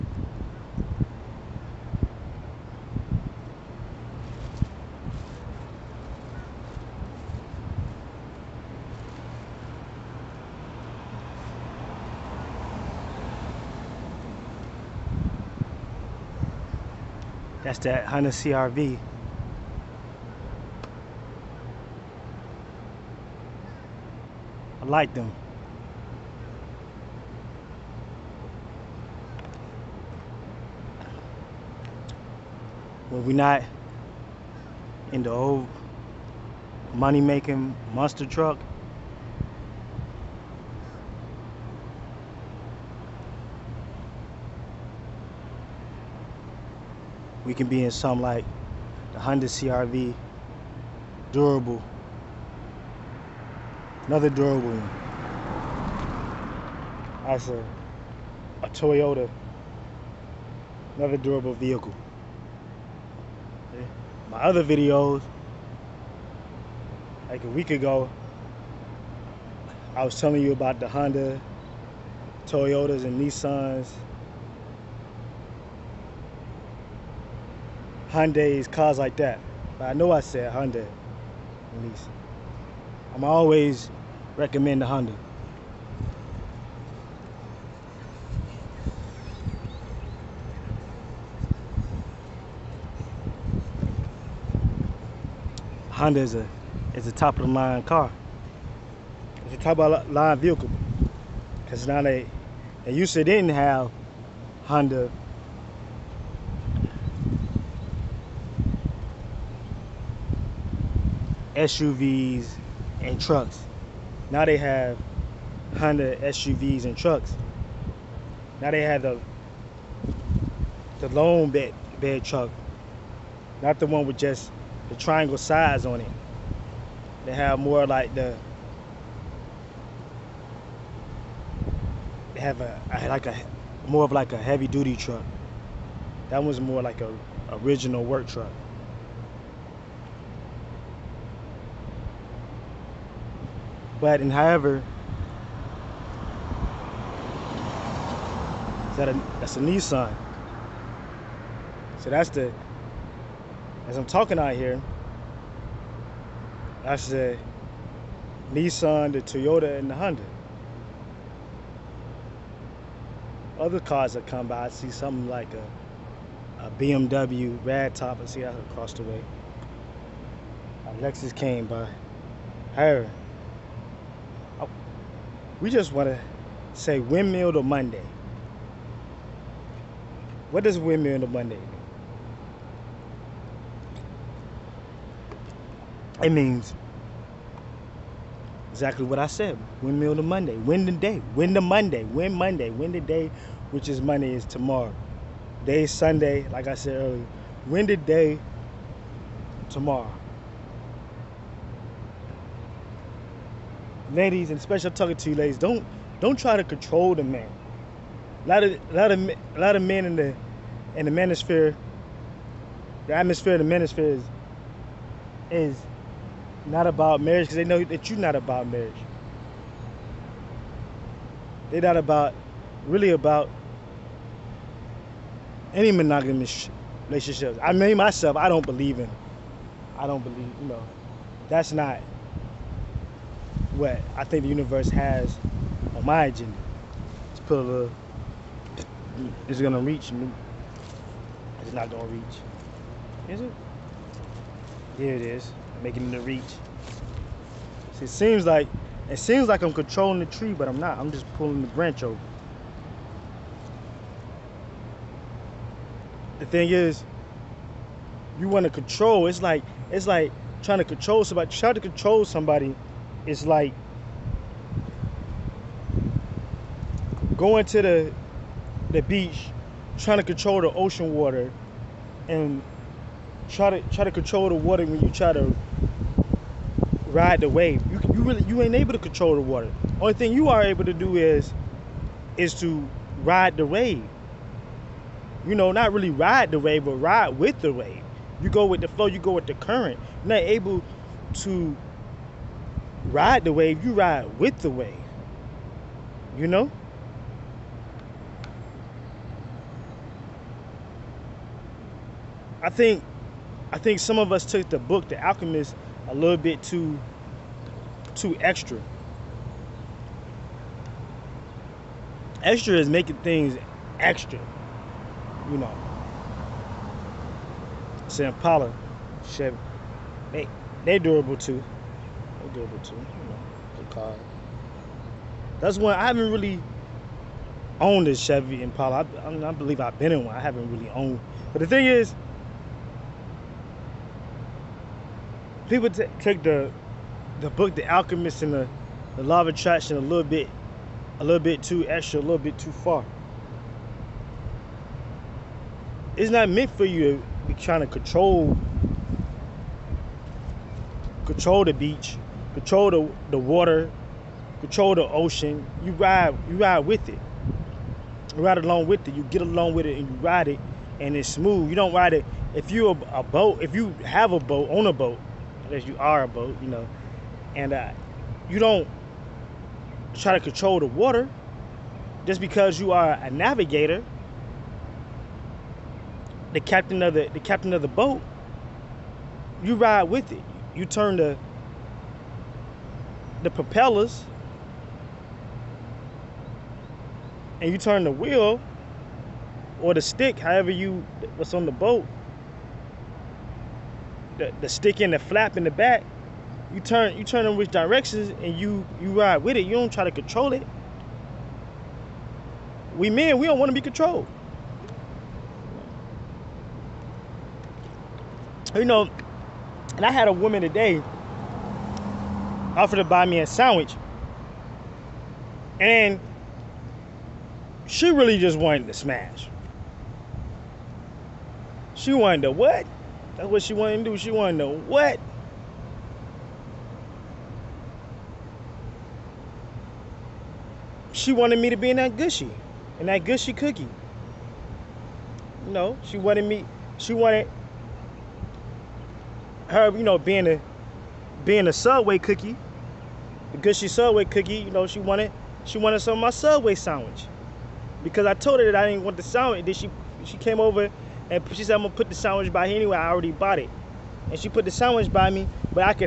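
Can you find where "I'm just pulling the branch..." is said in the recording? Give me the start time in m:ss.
4:10.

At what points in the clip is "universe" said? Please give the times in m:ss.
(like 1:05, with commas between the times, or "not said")
3:54.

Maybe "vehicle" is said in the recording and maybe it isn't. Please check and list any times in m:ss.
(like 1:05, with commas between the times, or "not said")
1:01, 1:40.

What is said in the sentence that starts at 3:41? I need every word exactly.
They're not about really about any monogamous relationships.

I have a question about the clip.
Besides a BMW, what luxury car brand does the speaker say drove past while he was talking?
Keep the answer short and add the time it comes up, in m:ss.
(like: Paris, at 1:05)
Lexus, at 2:50.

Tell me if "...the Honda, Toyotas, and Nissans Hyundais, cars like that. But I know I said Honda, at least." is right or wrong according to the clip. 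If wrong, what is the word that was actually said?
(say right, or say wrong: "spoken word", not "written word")
right.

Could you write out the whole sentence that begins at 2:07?
They have more like the they have a like a more of like a heavy duty truck.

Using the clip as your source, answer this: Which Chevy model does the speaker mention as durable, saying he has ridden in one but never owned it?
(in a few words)
Chevy Impala.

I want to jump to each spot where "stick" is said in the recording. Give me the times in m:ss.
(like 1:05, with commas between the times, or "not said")
6:30, 6:34.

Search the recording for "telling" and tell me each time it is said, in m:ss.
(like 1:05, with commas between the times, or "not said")
1:10.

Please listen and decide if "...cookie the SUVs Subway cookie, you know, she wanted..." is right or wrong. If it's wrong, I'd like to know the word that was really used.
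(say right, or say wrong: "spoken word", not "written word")
wrong: "Gushy", not "SUVs".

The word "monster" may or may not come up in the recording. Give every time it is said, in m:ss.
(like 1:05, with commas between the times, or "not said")
0:37.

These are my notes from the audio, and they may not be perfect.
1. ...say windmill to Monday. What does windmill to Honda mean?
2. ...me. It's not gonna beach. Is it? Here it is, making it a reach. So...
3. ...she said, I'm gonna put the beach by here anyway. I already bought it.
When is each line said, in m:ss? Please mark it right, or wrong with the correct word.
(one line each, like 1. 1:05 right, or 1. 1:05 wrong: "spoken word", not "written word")
1. 2:56 wrong: "Monday", not "Honda"
2. 4:00 wrong: "reach", not "beach"
3. 7:31 wrong: "sandwich", not "beach".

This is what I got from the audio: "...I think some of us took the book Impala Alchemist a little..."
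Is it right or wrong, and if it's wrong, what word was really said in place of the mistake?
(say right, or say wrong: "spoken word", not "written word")
wrong: "The", not "Impala".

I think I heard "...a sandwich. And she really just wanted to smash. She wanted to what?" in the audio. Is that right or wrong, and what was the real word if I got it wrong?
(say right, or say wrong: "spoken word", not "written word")
right.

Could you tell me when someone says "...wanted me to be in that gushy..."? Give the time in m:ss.
7:11.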